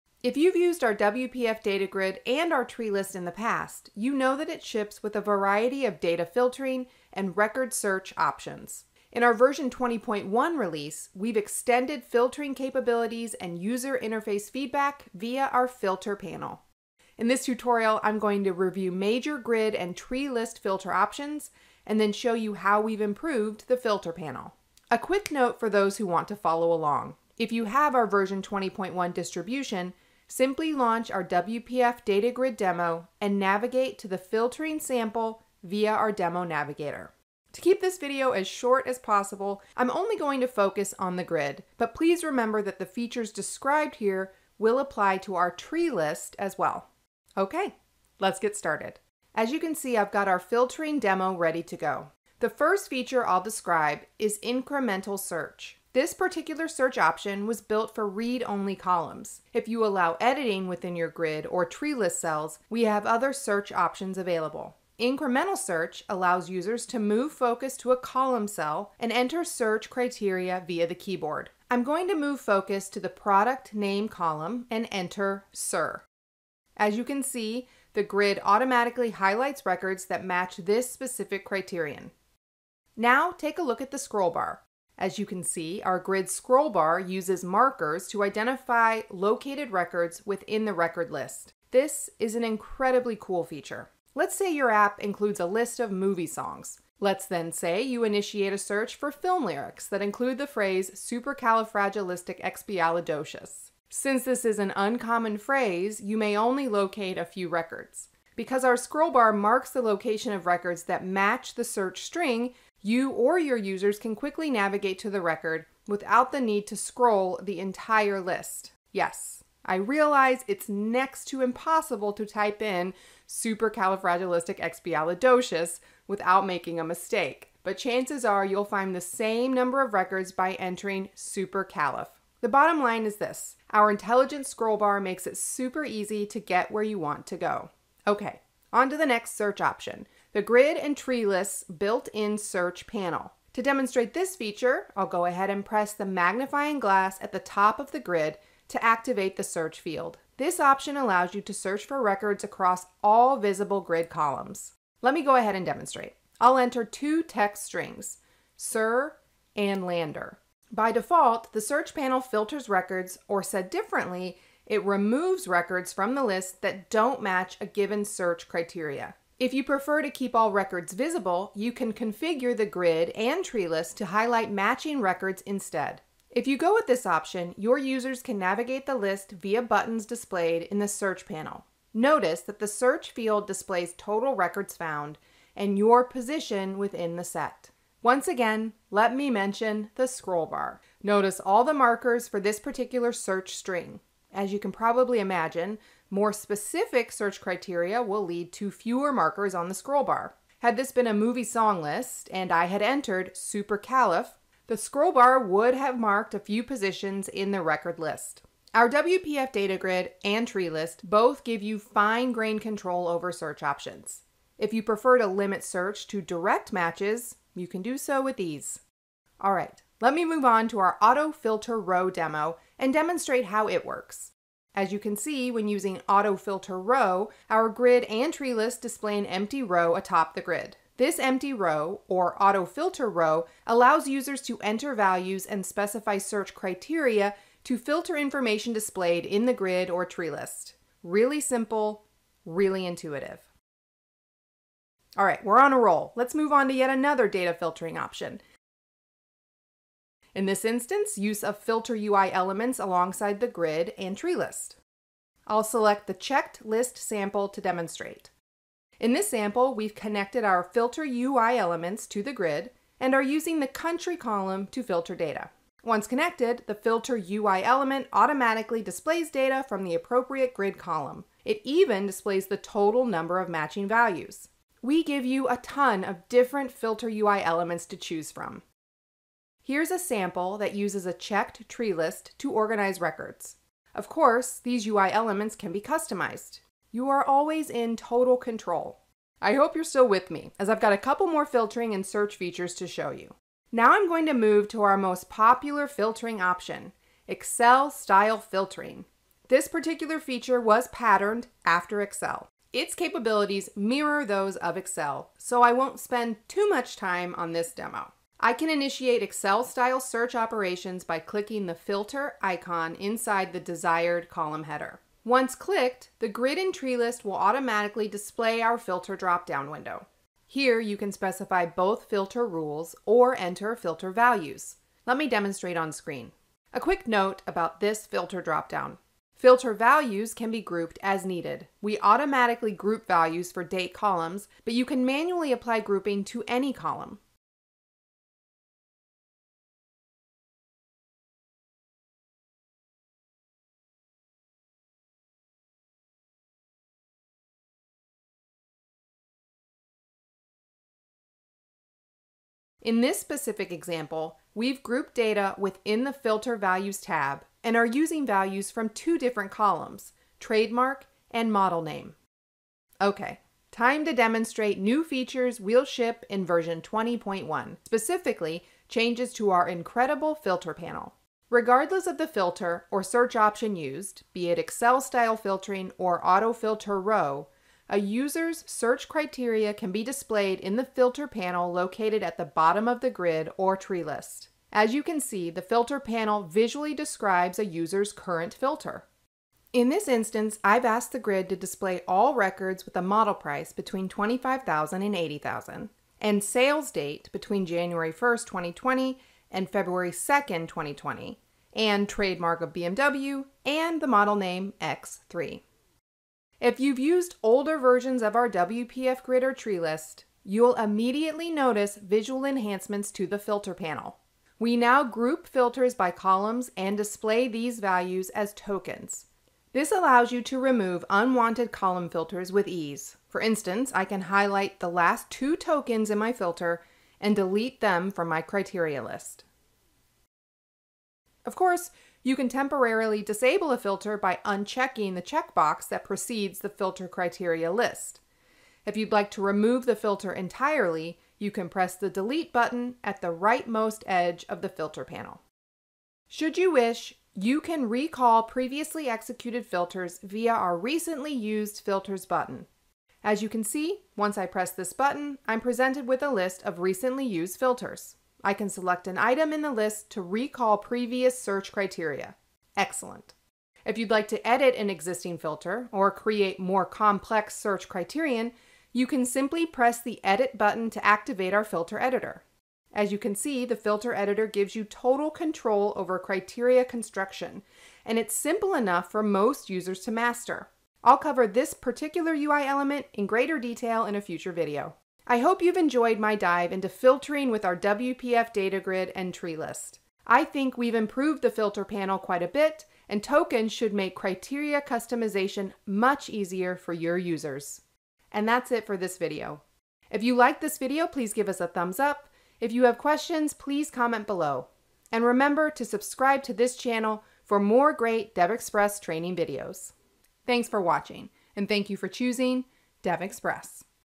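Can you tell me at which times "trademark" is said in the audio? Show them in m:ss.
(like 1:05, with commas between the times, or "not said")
6:00, 6:42.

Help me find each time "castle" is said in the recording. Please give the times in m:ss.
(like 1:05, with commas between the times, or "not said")
not said.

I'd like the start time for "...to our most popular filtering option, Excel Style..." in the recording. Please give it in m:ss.
4:54.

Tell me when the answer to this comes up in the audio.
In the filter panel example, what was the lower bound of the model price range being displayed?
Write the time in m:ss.
6:34.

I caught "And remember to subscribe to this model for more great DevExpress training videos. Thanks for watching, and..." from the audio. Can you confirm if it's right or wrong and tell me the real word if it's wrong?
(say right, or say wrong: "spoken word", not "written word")
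wrong: "channel", not "model".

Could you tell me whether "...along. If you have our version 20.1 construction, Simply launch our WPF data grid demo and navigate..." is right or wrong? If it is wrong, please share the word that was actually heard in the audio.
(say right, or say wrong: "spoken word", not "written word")
wrong: "distribution", not "construction".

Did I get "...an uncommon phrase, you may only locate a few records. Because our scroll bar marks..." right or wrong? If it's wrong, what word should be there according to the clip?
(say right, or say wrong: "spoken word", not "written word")
right.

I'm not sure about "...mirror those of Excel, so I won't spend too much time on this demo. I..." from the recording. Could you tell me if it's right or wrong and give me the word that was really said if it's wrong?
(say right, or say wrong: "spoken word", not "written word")
right.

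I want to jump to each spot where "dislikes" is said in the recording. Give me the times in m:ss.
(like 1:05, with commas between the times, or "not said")
not said.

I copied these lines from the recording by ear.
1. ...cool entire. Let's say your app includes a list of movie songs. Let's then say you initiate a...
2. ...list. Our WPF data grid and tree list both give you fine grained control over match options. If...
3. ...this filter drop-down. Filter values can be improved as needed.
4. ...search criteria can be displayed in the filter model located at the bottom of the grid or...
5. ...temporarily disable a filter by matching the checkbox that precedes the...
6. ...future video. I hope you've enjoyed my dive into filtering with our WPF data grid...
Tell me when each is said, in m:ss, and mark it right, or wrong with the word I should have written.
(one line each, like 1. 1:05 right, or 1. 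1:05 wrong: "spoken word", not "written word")
1. 1:33 wrong: "feature", not "entire"
2. 3:27 wrong: "search", not "match"
3. 5:27 wrong: "grouped", not "improved"
4. 6:18 wrong: "panel", not "model"
5. 7:12 wrong: "unchecking", not "matching"
6. 8:04 right.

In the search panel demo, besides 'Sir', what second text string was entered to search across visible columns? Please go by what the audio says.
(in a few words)
Lander.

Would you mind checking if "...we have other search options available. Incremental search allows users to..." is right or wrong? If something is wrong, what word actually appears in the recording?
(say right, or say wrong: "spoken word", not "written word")
right.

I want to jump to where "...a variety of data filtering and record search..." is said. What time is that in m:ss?
0:05.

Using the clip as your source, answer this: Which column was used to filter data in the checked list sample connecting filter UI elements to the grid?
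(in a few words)
country.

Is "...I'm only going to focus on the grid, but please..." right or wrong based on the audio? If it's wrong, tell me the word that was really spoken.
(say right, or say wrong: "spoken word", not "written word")
right.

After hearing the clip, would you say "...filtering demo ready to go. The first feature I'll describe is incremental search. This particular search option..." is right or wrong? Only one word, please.
right.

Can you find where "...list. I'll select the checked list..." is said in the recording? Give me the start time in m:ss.
4:14.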